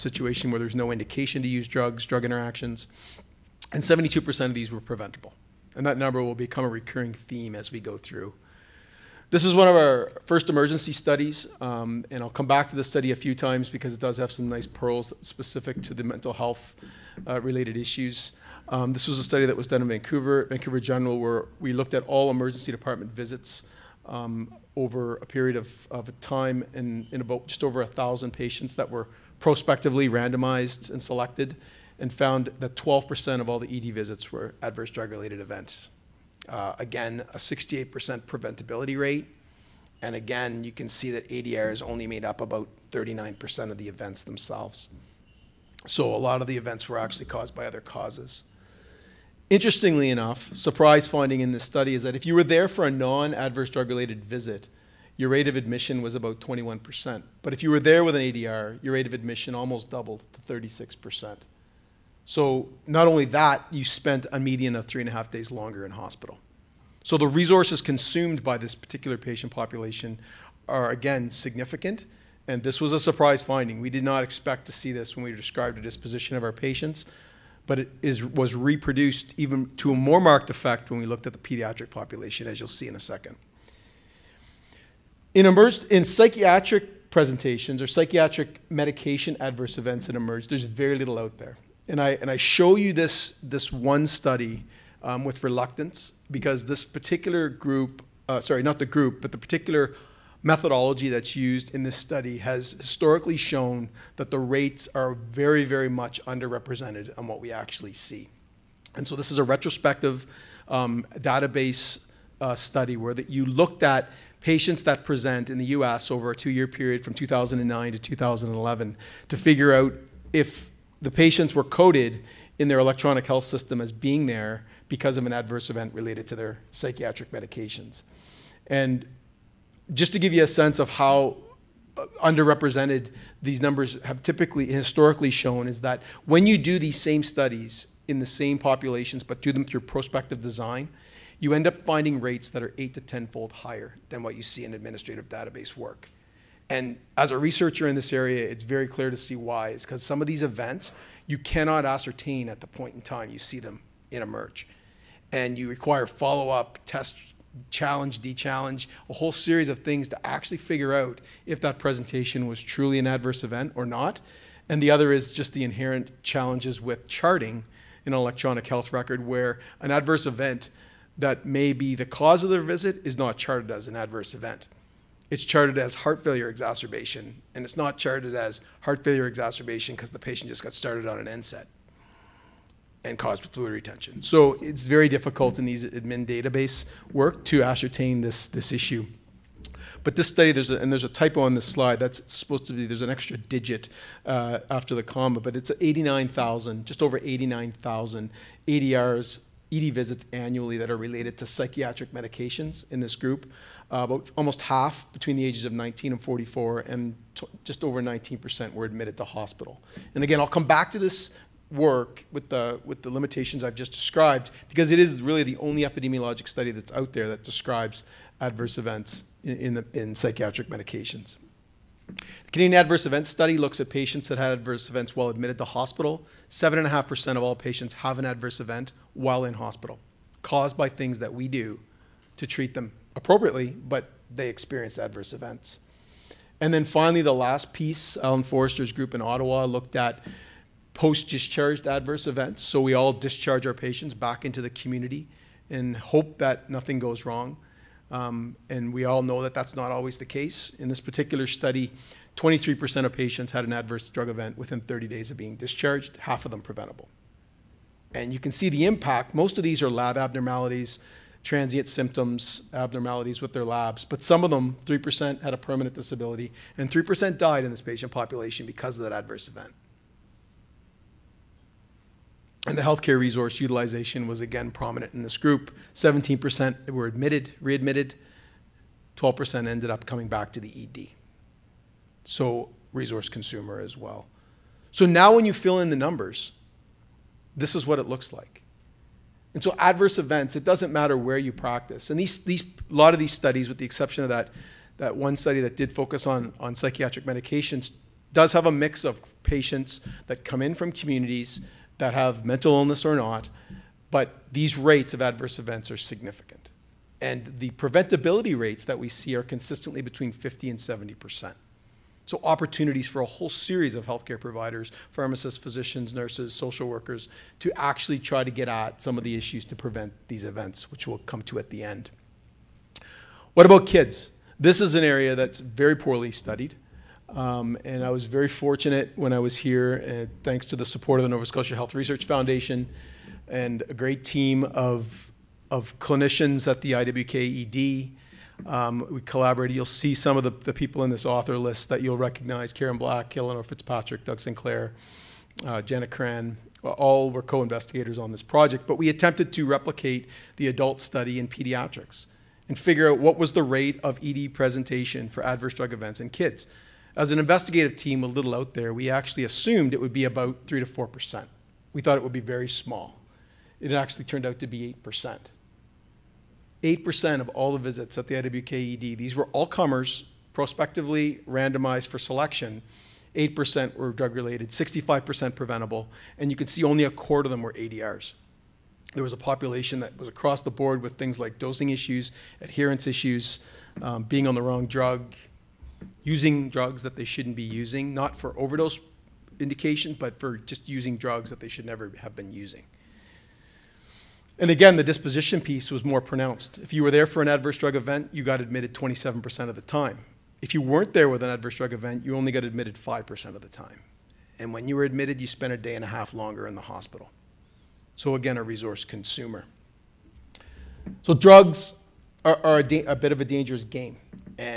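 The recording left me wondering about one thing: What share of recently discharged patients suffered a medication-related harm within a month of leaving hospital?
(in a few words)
23%.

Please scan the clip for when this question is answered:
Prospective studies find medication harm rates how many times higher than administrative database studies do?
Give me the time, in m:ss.
2:22.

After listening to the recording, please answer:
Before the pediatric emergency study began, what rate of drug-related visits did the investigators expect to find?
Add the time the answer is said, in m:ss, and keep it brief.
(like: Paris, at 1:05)
3 to 4%, at 6:00.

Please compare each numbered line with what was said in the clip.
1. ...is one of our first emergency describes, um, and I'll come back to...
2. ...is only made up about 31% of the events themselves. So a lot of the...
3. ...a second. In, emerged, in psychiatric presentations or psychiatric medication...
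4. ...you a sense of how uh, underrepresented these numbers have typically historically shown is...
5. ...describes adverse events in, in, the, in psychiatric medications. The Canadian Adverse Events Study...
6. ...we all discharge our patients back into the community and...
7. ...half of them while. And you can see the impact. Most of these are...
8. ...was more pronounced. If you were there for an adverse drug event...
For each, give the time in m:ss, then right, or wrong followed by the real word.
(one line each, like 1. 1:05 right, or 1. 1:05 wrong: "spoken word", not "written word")
1. 0:09 wrong: "studies", not "describes"
2. 0:41 wrong: "39", not "31"
3. 1:22 right
4. 2:10 right
5. 3:37 right
6. 4:02 right
7. 4:16 wrong: "preventable", not "while"
8. 6:35 right.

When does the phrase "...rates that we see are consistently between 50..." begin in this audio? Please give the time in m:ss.
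5:08.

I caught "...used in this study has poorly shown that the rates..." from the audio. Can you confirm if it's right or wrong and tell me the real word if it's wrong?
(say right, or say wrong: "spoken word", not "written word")
wrong: "historically", not "poorly".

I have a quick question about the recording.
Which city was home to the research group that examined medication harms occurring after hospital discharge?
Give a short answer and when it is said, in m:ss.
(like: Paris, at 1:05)
Ottawa, at 3:59.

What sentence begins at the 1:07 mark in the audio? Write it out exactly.
So the resources consumed by this particular patient population are again significant.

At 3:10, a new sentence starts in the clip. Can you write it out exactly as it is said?
But this study, there's a, and there's a typo on this slide.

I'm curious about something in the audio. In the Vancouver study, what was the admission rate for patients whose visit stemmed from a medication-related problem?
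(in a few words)
36%.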